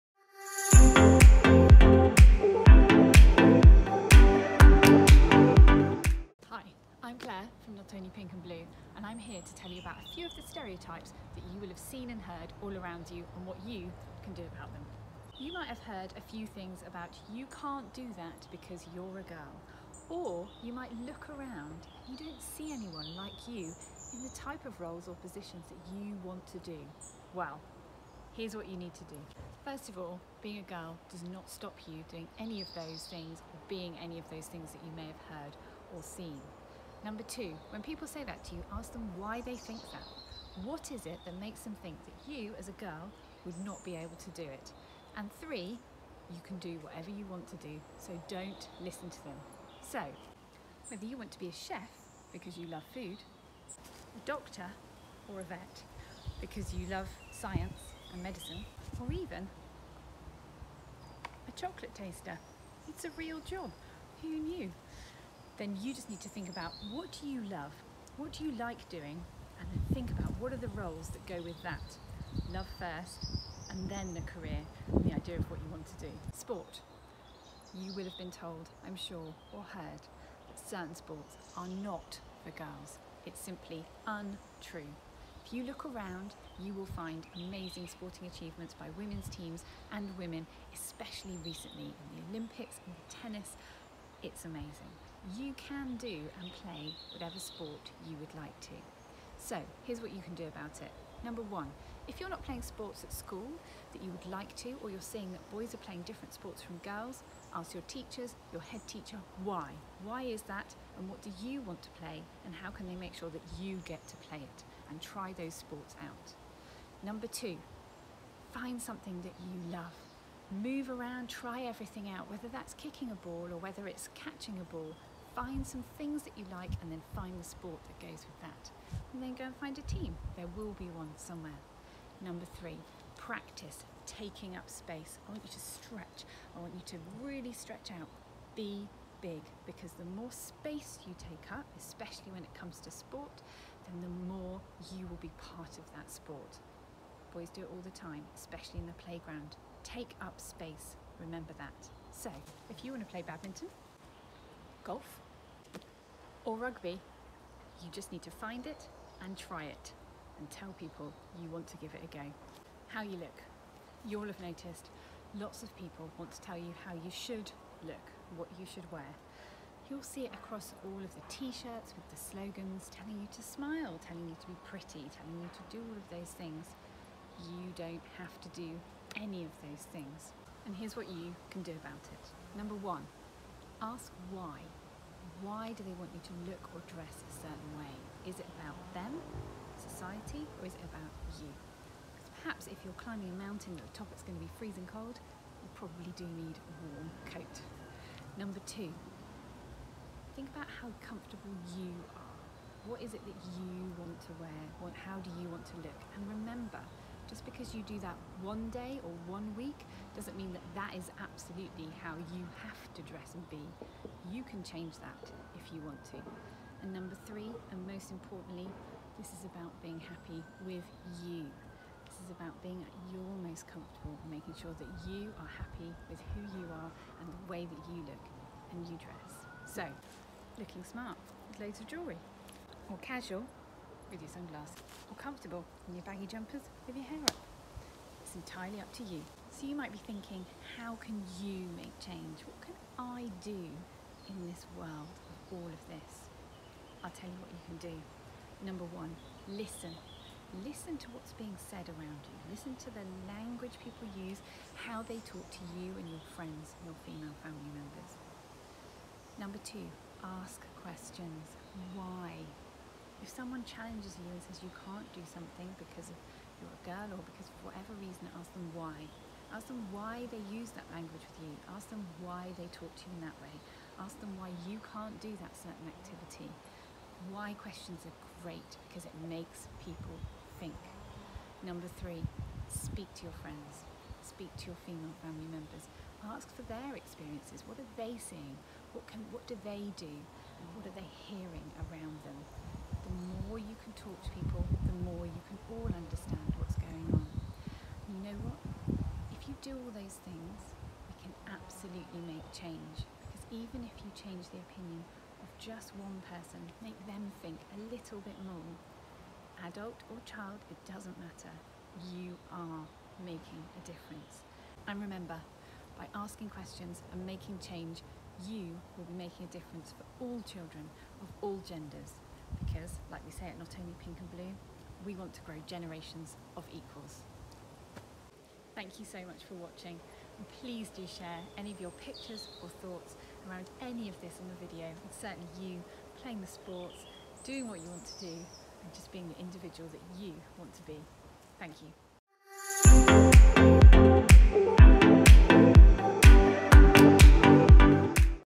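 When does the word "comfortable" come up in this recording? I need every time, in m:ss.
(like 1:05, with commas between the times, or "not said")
3:21, 3:43, 3:55.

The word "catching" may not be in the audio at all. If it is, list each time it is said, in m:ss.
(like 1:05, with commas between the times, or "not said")
2:04.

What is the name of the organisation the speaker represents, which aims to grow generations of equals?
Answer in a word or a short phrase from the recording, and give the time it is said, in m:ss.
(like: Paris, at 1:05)
Not Only Pink and Blue, at 5:23.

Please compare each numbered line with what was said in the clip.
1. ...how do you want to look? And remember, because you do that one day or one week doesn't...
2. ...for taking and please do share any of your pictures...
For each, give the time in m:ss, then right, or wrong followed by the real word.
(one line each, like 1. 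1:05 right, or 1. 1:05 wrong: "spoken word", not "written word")
1. 3:24 right
2. 5:29 wrong: "watching", not "taking".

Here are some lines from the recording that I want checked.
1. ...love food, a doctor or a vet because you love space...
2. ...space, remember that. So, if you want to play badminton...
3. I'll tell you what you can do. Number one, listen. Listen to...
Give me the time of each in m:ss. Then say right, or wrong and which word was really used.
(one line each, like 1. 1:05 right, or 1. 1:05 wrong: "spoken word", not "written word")
1. 0:52 wrong: "science", not "space"
2. 2:30 right
3. 4:07 right.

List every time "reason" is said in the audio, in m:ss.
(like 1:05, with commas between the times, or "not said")
4:27.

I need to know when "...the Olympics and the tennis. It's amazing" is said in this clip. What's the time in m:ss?
1:32.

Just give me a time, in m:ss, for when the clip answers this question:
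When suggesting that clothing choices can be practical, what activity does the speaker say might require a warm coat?
3:13.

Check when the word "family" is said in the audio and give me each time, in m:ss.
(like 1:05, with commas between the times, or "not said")
4:17, 4:45.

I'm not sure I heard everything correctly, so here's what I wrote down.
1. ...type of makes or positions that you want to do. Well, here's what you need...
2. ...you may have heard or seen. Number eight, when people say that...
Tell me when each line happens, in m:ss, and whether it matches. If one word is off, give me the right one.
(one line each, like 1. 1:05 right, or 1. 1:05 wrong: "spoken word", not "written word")
1. 0:24 wrong: "roles", not "makes"
2. 0:34 wrong: "two", not "eight".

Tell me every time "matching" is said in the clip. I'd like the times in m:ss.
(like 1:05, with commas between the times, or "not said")
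not said.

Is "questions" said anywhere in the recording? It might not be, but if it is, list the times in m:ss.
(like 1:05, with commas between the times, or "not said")
4:20, 4:37, 5:16.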